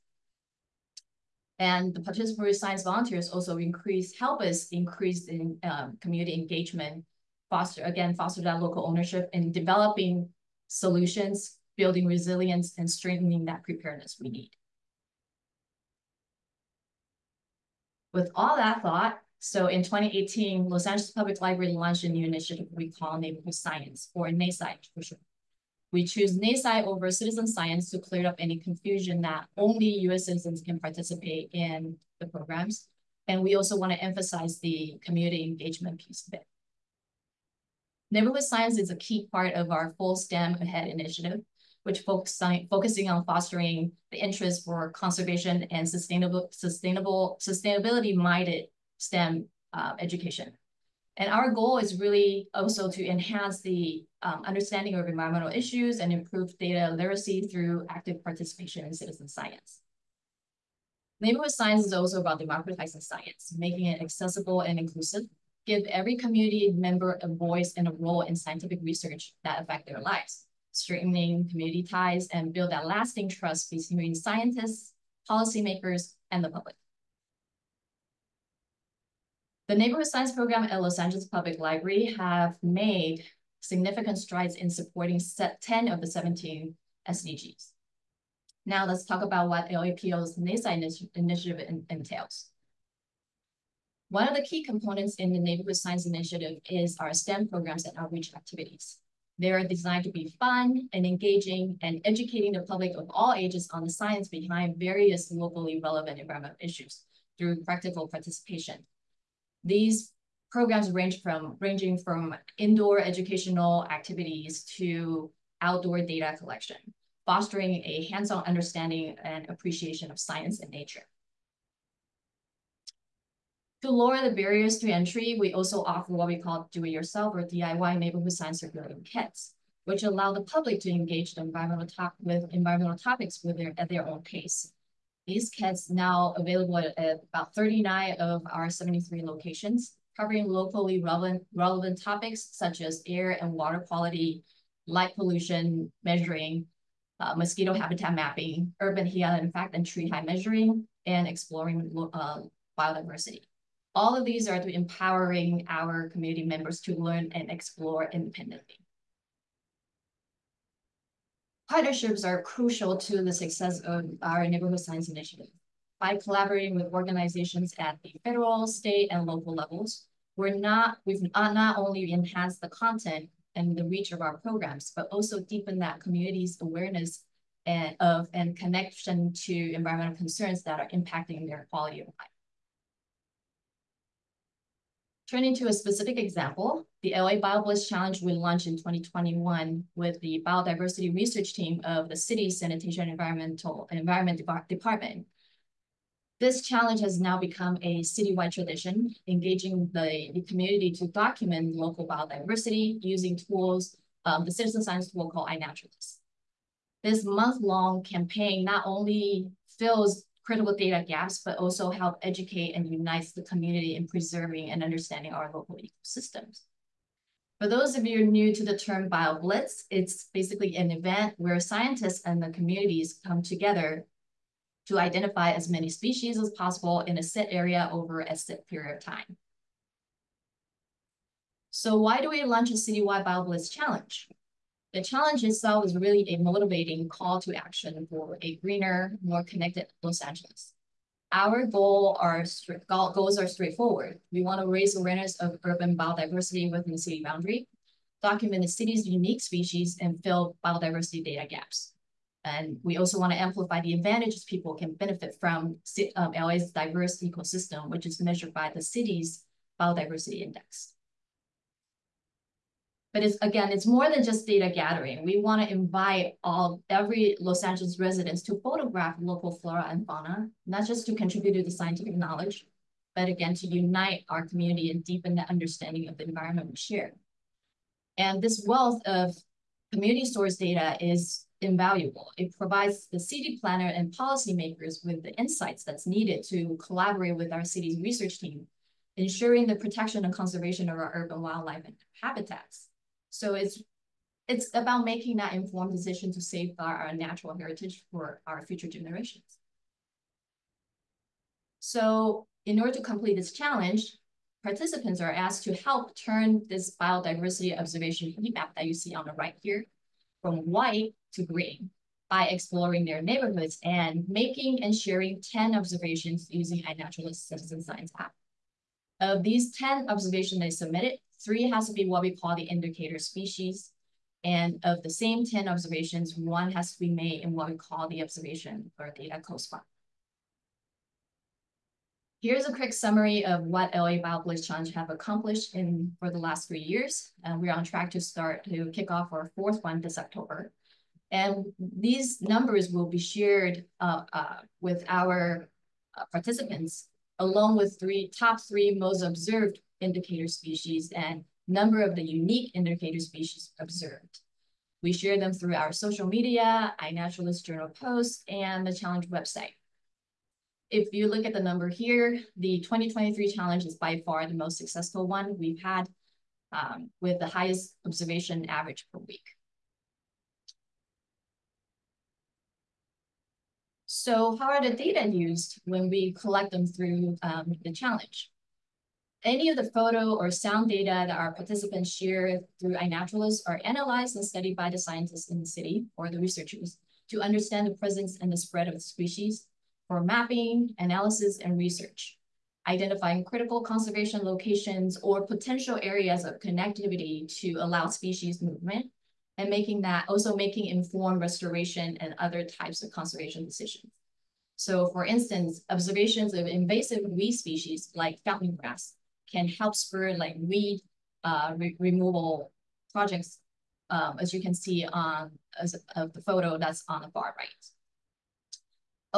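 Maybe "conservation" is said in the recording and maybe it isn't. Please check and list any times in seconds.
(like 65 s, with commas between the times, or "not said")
44 s, 290 s, 393 s, 403 s.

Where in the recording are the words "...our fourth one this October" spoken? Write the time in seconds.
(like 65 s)
339 s.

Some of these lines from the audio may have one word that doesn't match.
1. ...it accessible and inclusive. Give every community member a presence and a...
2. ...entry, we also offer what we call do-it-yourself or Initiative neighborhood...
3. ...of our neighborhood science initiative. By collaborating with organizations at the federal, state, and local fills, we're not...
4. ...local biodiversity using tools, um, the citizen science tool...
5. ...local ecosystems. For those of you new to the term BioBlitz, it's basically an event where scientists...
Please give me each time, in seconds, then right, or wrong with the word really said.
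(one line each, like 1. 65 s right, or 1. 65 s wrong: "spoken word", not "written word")
1. 63 s wrong: "voice", not "presence"
2. 124 s wrong: "DIY", not "Initiative"
3. 163 s wrong: "levels", not "fills"
4. 201 s right
5. 215 s right.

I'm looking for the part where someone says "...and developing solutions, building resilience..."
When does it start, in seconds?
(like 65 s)
9 s.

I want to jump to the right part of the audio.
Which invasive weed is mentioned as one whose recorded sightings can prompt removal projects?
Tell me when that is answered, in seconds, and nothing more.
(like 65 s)
408 s.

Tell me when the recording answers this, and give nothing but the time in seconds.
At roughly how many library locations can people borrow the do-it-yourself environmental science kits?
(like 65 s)
137 s.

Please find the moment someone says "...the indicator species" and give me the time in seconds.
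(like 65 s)
322 s.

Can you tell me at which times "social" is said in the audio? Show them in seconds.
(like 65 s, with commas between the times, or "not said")
355 s.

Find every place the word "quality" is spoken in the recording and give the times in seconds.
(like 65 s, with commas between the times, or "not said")
143 s, 181 s.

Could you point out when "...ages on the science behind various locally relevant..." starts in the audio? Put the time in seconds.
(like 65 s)
103 s.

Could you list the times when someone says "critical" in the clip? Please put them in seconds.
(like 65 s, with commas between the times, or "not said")
210 s, 393 s.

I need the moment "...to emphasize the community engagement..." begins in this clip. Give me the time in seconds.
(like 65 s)
33 s.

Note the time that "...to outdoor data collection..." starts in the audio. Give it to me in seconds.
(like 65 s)
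114 s.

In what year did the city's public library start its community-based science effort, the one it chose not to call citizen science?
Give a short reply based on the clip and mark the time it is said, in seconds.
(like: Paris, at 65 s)
2018, at 19 s.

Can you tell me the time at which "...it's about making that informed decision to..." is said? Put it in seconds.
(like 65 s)
294 s.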